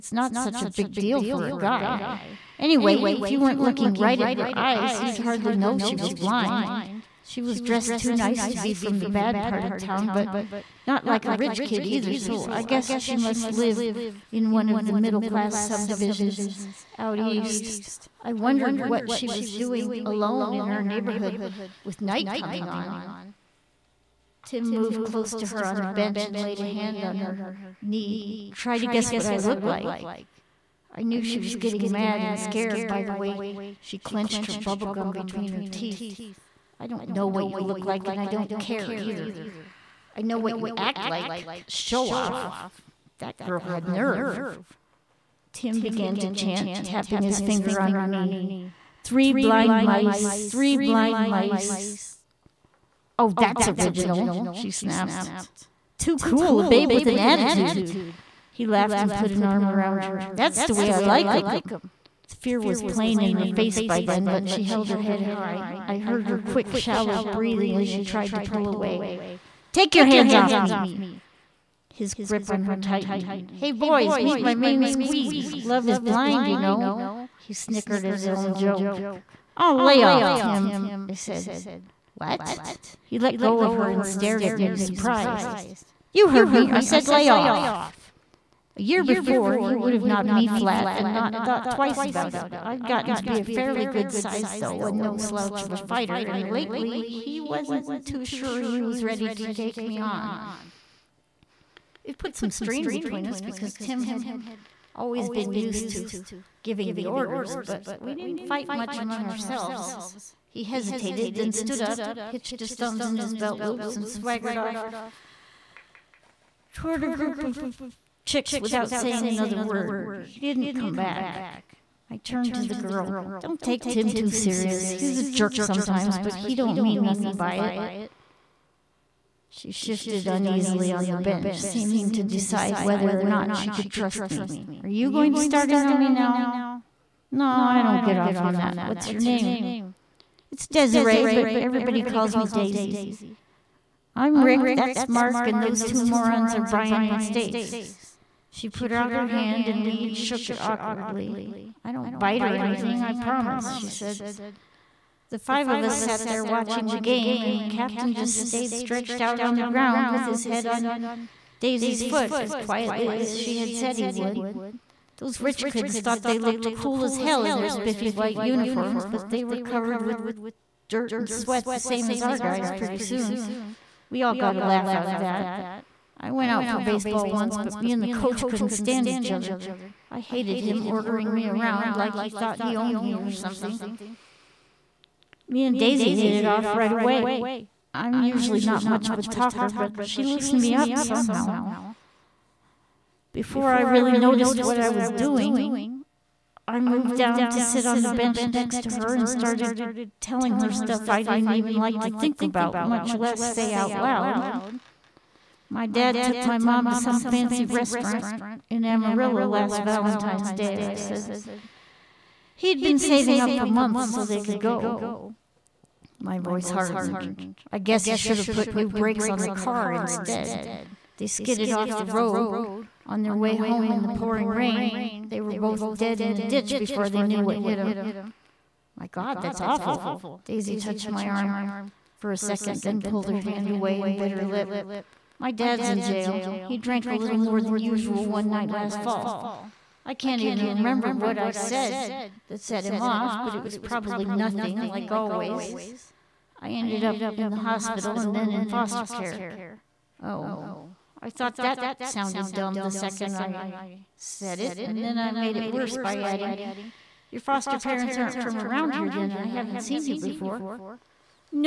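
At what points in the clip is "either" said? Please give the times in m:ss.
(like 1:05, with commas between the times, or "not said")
0:11, 0:38.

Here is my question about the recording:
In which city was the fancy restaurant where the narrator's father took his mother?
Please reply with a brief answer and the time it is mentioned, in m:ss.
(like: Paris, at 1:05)
Amarillo, at 3:28.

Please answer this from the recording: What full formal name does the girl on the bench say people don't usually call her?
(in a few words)
Desiree.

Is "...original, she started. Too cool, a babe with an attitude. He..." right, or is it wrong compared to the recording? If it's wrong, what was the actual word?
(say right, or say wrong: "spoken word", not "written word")
wrong: "snapped", not "started".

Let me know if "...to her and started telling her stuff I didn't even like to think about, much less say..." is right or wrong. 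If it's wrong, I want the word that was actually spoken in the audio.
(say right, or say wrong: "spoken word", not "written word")
right.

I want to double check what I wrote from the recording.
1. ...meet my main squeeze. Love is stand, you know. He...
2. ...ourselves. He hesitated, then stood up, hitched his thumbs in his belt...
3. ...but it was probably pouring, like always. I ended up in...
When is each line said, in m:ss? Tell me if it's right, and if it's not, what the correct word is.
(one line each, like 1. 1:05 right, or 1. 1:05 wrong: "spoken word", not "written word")
1. 1:14 wrong: "blind", not "stand"
2. 1:49 right
3. 4:03 wrong: "nothing", not "pouring".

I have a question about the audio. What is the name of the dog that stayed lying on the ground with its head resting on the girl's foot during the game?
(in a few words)
Captain.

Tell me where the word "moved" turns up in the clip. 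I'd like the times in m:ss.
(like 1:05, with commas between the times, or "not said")
0:24, 3:16.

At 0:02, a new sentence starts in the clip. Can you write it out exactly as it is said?
Anyway, if you weren't looking right at her eyes, you'd hardly know she was blind.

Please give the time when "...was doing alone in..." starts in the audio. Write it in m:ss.
0:19.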